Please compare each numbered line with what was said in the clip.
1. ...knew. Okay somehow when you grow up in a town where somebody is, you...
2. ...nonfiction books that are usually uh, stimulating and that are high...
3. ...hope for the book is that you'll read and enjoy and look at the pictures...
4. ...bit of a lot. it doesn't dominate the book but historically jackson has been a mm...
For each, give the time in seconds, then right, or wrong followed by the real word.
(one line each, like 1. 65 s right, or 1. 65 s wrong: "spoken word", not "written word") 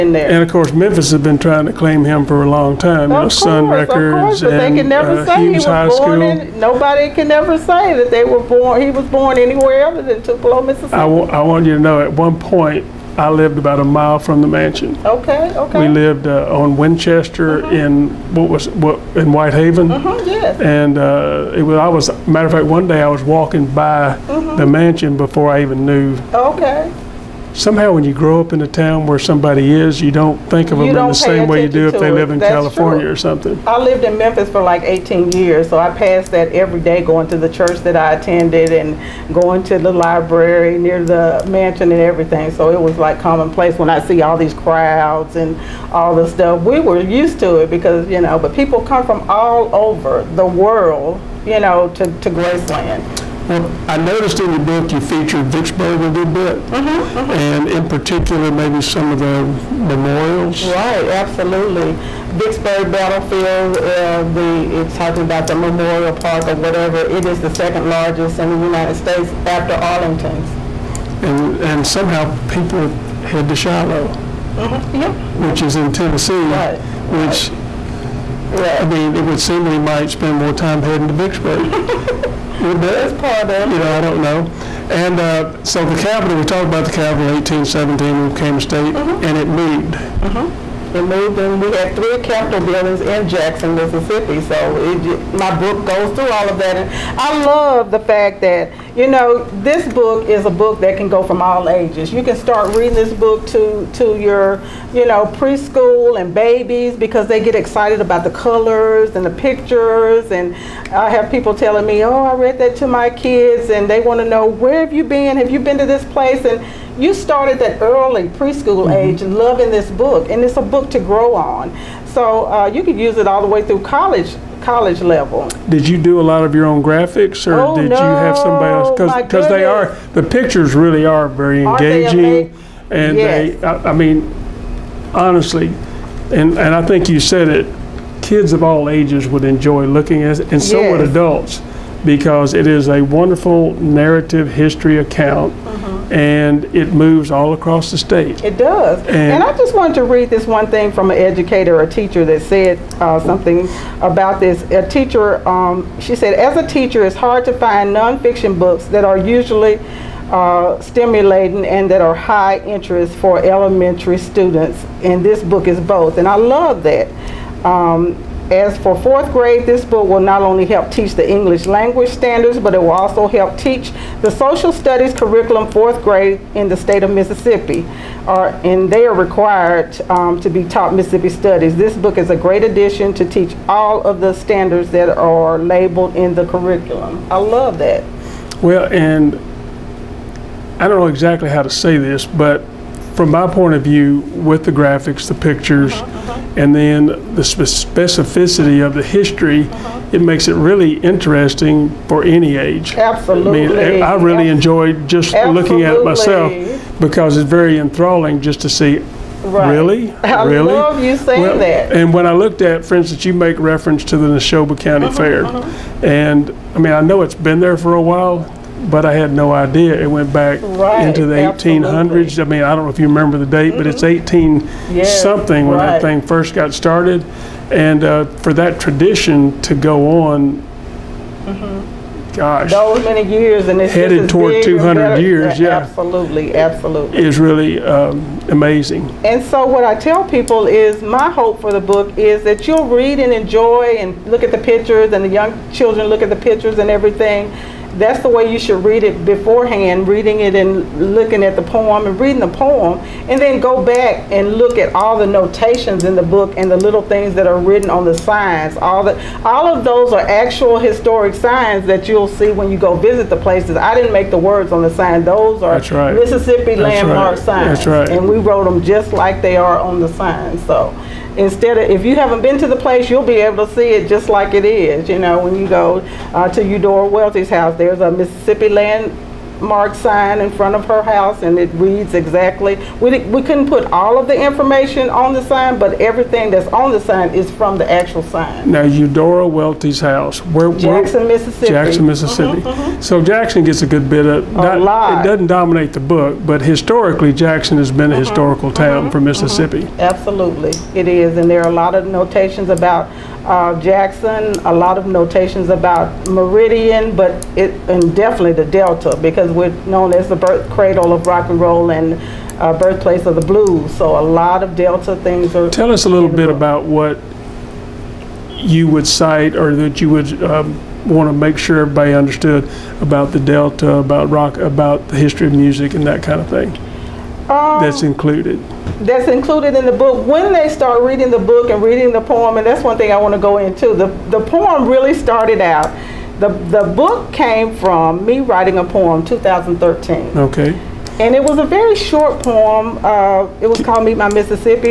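1. 25 s right
2. 157 s right
3. 241 s right
4. 294 s right.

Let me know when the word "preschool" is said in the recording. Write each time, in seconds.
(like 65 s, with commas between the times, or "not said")
105 s, 118 s.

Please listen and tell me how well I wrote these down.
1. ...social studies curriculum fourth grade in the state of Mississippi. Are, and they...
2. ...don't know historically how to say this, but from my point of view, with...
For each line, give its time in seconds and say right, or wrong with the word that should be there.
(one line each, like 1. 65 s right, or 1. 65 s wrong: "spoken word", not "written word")
1. 174 s right
2. 190 s wrong: "exactly", not "historically".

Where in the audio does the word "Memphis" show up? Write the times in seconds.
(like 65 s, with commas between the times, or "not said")
0 s, 34 s.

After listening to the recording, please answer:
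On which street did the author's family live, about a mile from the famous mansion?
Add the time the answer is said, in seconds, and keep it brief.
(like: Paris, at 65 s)
Winchester, at 16 s.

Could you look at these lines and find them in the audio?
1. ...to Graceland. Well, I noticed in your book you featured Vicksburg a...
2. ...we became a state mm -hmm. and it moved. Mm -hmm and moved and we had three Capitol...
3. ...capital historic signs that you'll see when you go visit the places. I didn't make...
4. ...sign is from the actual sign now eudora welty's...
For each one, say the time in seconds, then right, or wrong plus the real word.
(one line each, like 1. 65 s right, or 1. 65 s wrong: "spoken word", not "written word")
1. 52 s right
2. 88 s right
3. 260 s wrong: "actual", not "capital"
4. 287 s right.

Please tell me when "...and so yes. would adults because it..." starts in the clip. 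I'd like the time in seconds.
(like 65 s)
140 s.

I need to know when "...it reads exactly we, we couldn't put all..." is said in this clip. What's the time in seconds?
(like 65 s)
281 s.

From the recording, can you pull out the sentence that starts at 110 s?
And I have people telling me, oh, I read that to my kids and they want to know, where have you been?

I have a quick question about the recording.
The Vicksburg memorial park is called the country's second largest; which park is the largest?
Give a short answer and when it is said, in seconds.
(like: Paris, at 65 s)
Arlington, at 69 s.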